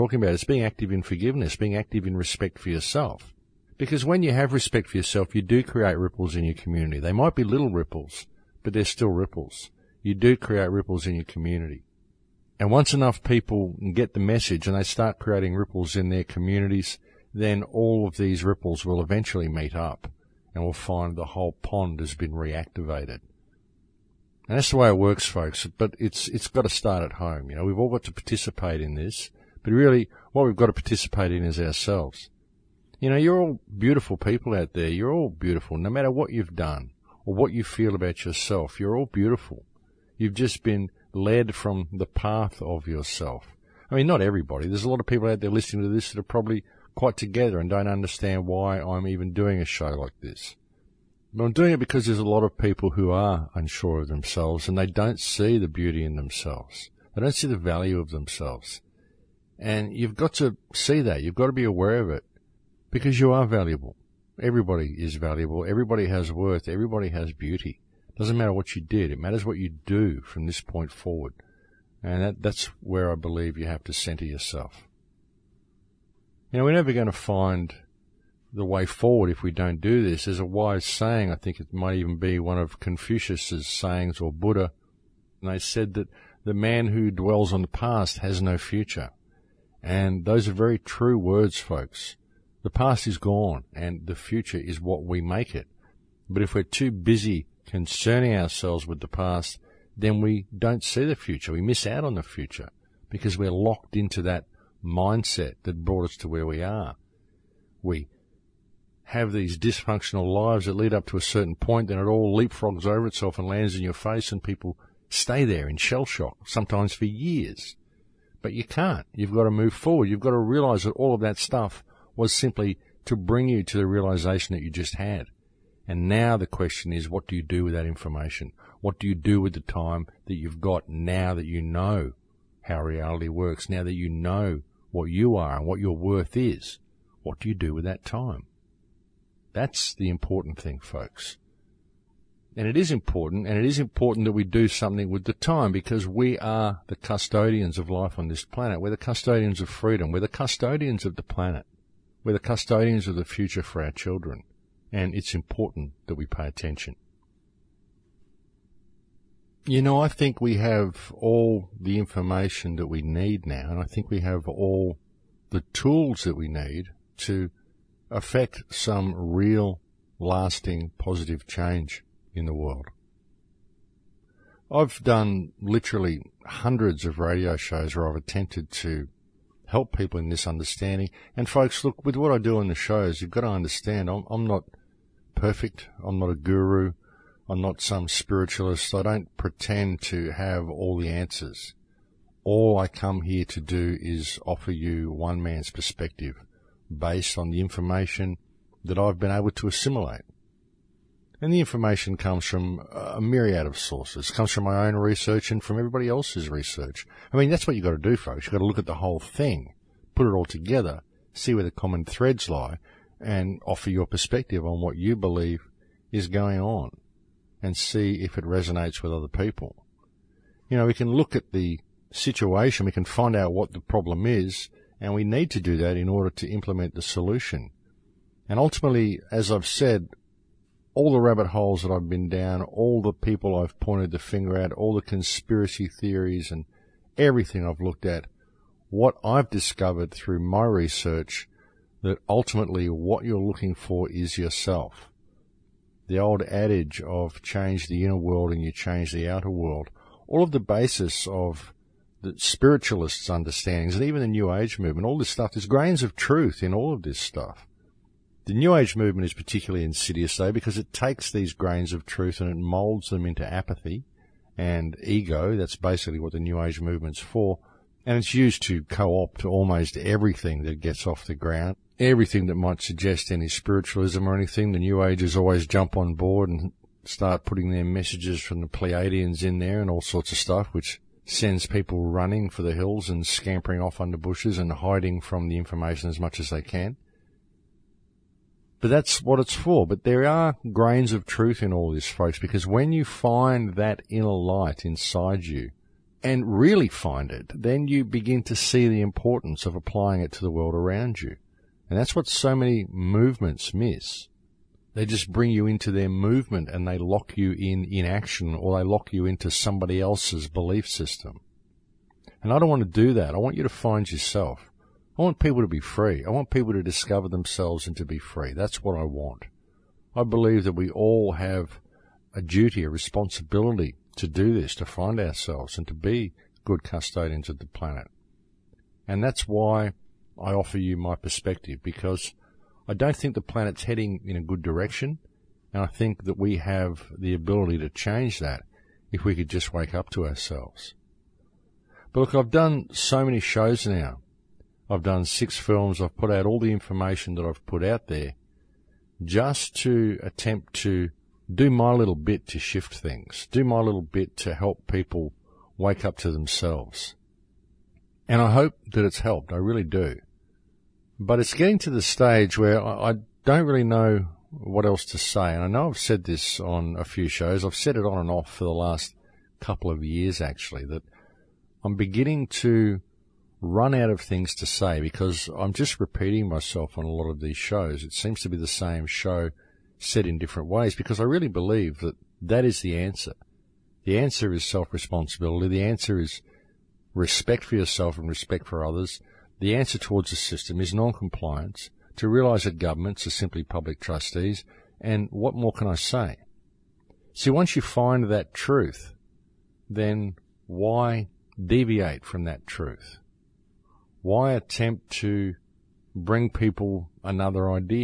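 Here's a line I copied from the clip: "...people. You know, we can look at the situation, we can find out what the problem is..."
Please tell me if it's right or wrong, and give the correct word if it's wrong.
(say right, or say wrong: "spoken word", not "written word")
right.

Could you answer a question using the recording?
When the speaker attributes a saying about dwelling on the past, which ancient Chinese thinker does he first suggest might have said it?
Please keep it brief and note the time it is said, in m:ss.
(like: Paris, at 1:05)
Confucius, at 1:22.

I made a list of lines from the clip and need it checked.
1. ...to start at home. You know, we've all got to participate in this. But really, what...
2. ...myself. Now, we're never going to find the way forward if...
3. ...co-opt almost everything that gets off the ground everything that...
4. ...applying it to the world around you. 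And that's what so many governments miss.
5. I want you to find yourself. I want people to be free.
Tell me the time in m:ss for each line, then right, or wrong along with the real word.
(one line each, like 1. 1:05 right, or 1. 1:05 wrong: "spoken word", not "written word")
1. 0:26 right
2. 1:14 wrong: "yourself", not "myself"
3. 4:28 right
4. 4:59 wrong: "movements", not "governments"
5. 5:13 right.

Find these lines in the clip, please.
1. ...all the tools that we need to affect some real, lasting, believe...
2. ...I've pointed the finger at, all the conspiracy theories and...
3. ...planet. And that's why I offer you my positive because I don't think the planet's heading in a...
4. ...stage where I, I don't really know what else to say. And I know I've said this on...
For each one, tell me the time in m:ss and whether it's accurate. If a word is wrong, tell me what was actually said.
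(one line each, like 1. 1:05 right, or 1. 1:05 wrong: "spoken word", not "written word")
1. 2:44 wrong: "positive", not "believe"
2. 3:53 right
3. 5:27 wrong: "perspective", not "positive"
4. 6:02 right.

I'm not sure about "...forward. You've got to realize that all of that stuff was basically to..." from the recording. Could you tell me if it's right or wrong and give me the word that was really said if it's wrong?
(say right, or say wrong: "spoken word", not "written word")
wrong: "simply", not "basically".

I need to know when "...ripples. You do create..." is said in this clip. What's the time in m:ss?
0:09.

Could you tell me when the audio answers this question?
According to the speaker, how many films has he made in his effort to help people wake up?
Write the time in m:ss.
5:45.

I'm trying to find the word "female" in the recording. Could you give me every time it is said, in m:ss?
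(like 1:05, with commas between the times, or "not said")
not said.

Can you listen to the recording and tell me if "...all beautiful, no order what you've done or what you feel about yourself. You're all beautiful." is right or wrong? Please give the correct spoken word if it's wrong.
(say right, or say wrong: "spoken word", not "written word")
wrong: "matter", not "order".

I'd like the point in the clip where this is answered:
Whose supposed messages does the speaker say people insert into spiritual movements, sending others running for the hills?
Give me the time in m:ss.
4:38.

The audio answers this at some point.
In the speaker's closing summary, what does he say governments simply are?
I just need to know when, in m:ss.
6:33.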